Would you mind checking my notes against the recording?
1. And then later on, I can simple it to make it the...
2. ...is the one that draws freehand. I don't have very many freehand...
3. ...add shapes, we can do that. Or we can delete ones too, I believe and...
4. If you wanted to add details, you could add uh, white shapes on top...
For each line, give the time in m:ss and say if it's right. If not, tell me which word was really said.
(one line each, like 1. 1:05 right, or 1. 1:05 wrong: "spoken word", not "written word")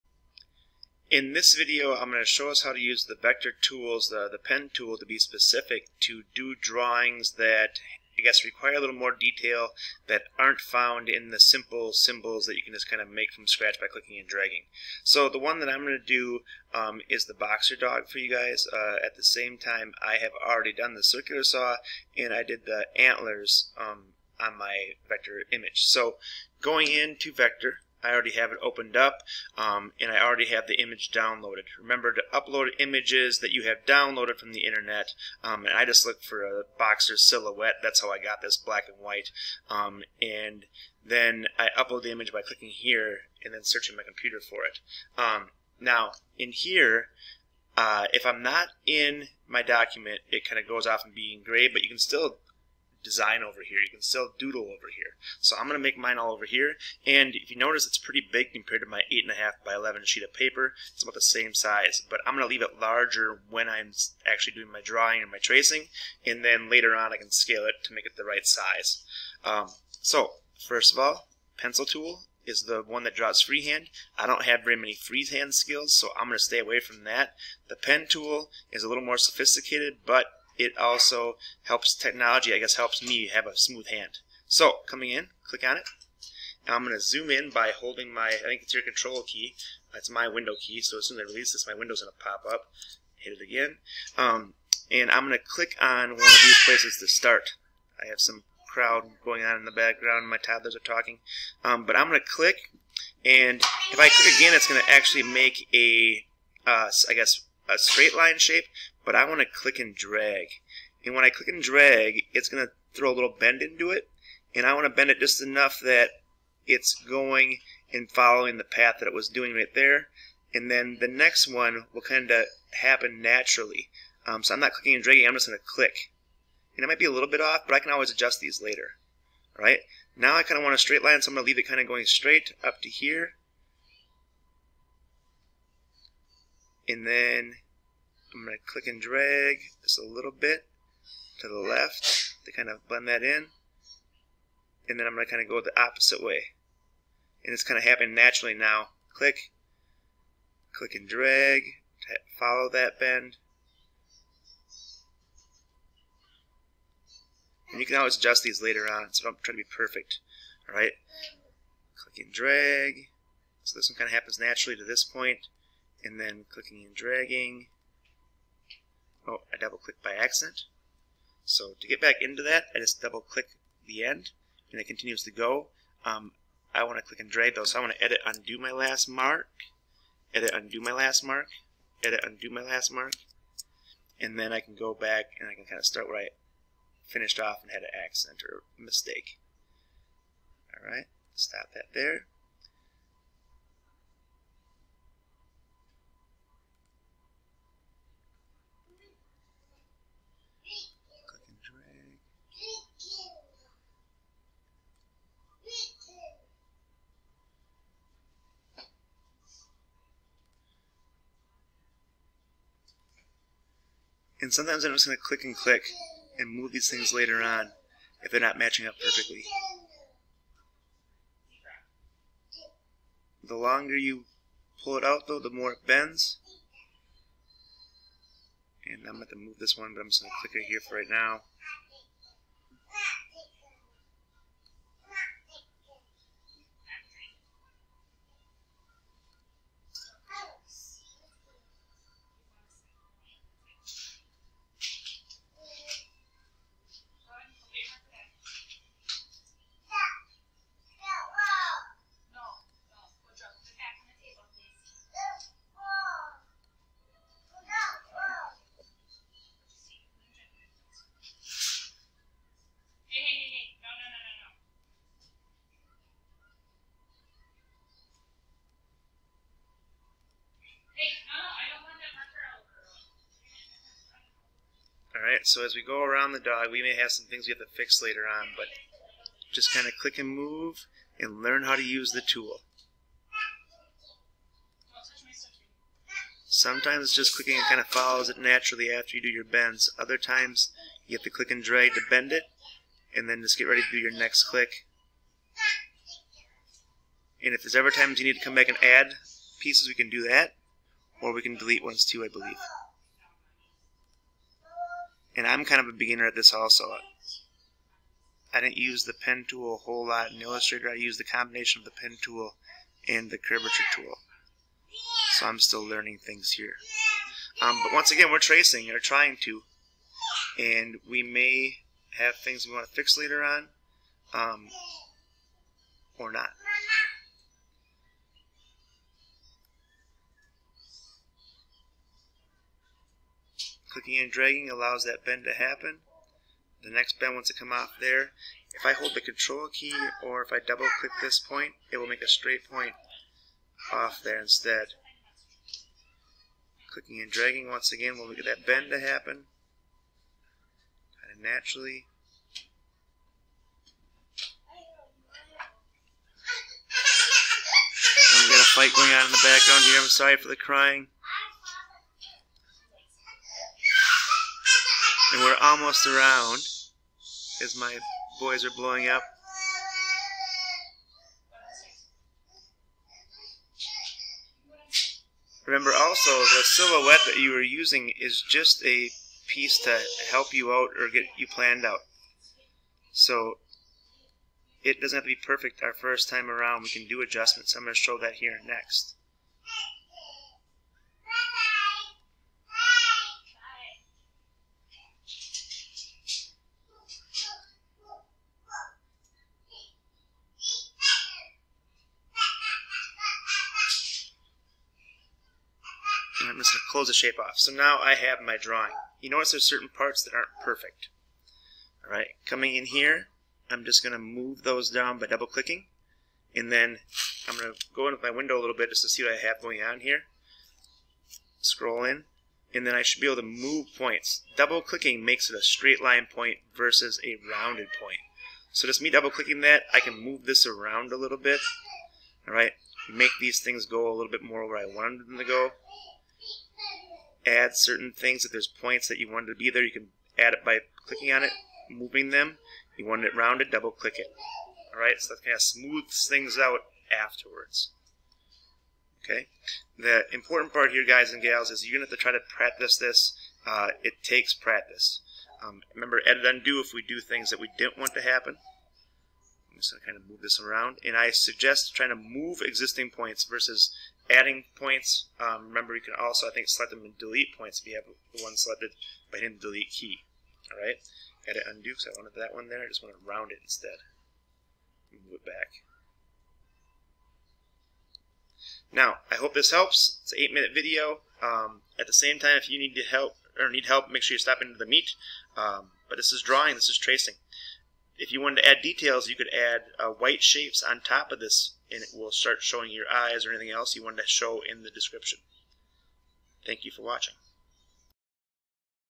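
1. 1:06 wrong: "scale", not "simple"
2. 1:12 right
3. 4:58 wrong: "pieces", not "shapes"
4. 8:08 right.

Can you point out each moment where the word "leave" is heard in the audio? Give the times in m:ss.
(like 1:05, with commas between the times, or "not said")
1:02, 2:11.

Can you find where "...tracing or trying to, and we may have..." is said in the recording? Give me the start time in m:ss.
5:18.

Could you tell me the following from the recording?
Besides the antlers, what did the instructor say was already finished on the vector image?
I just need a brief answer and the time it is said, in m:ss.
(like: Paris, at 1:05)
Circular saw, at 0:21.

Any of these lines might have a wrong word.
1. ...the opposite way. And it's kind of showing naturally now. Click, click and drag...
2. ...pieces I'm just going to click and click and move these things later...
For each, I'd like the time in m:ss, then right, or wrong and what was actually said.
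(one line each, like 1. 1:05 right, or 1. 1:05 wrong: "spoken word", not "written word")
1. 2:25 wrong: "happening", not "showing"
2. 3:34 wrong: "sometimes", not "pieces".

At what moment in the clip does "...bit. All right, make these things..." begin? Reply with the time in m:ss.
7:11.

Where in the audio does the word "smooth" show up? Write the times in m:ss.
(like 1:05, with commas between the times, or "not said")
1:23, 7:25.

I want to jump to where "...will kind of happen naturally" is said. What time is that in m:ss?
2:01.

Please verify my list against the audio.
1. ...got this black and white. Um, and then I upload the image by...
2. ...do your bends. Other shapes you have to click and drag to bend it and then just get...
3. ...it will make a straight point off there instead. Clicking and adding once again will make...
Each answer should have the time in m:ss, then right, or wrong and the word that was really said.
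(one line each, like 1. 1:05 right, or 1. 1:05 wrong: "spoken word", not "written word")
1. 0:38 right
2. 4:49 wrong: "times", not "shapes"
3. 5:41 wrong: "dragging", not "adding".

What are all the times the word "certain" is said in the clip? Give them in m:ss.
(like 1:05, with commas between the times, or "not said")
6:49, 7:17.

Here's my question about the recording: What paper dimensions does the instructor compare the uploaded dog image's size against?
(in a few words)
8.5 by 11.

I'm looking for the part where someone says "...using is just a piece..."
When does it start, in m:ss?
6:17.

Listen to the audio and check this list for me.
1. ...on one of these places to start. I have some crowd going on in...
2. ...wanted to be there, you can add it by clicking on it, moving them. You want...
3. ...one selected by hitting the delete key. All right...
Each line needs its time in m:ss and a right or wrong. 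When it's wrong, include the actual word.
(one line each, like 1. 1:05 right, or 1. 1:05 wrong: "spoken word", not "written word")
1. 1:35 right
2. 7:19 right
3. 7:48 right.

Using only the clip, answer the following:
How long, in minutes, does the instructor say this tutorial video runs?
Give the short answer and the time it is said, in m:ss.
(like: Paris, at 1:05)
8, at 8:00.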